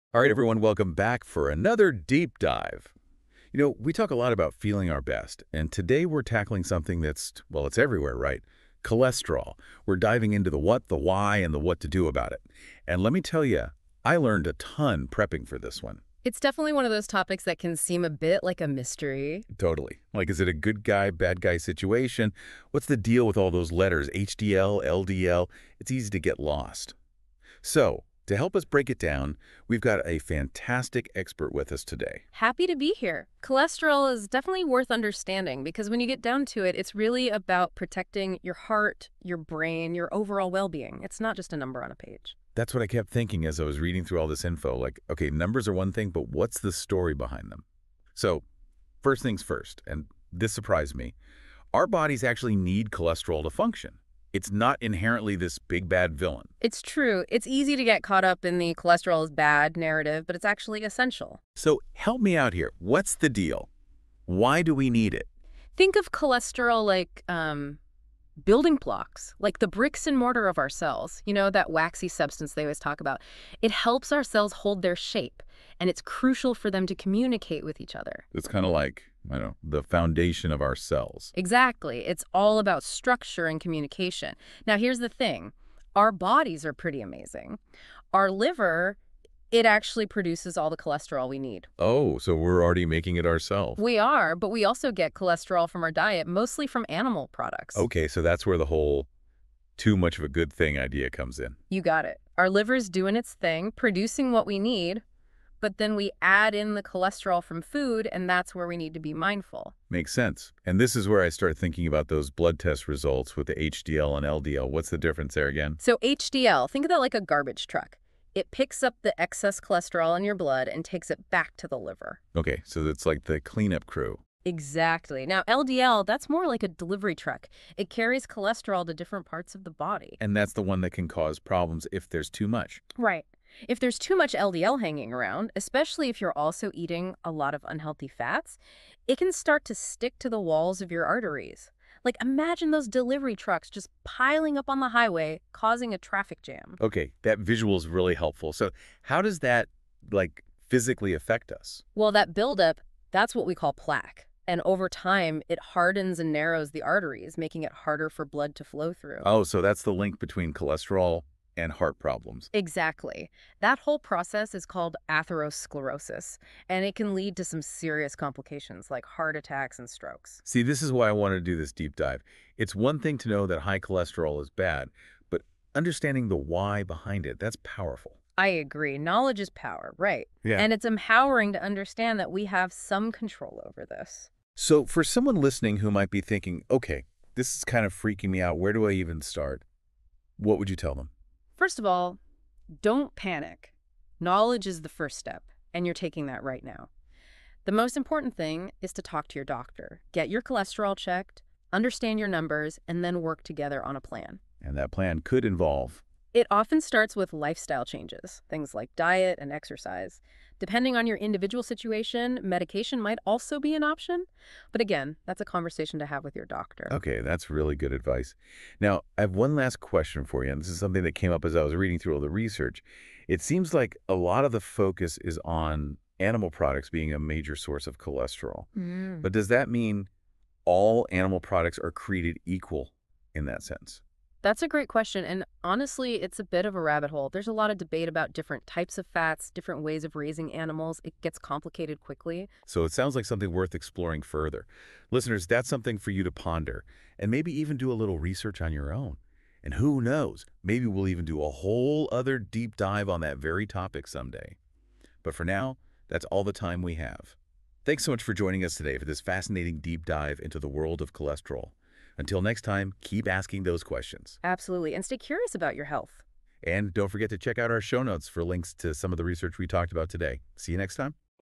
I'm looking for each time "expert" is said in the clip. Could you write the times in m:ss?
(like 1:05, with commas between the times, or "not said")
0:31.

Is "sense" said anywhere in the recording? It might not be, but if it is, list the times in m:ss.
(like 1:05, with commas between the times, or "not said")
1:50, 3:53.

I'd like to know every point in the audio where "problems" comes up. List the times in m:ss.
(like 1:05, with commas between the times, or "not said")
2:11, 2:41.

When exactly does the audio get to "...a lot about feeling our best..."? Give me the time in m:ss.
0:04.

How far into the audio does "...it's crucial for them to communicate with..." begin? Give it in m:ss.
1:15.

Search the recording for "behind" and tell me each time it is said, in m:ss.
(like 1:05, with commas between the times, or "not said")
0:47, 2:56.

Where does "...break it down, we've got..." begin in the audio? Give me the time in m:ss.
0:28.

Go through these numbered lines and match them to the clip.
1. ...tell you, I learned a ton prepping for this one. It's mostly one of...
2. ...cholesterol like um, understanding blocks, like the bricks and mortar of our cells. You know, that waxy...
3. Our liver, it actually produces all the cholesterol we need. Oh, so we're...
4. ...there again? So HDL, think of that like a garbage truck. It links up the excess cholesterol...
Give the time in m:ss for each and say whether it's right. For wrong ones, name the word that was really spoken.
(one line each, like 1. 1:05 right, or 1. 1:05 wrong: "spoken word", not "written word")
1. 0:13 wrong: "definitely", not "mostly"
2. 1:06 wrong: "building", not "understanding"
3. 1:28 right
4. 1:55 wrong: "picks", not "links".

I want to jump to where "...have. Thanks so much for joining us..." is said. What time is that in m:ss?
4:16.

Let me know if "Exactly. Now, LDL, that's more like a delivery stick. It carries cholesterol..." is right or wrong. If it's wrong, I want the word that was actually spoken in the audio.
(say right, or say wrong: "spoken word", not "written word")
wrong: "truck", not "stick".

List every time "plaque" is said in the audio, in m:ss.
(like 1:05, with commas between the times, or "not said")
2:33.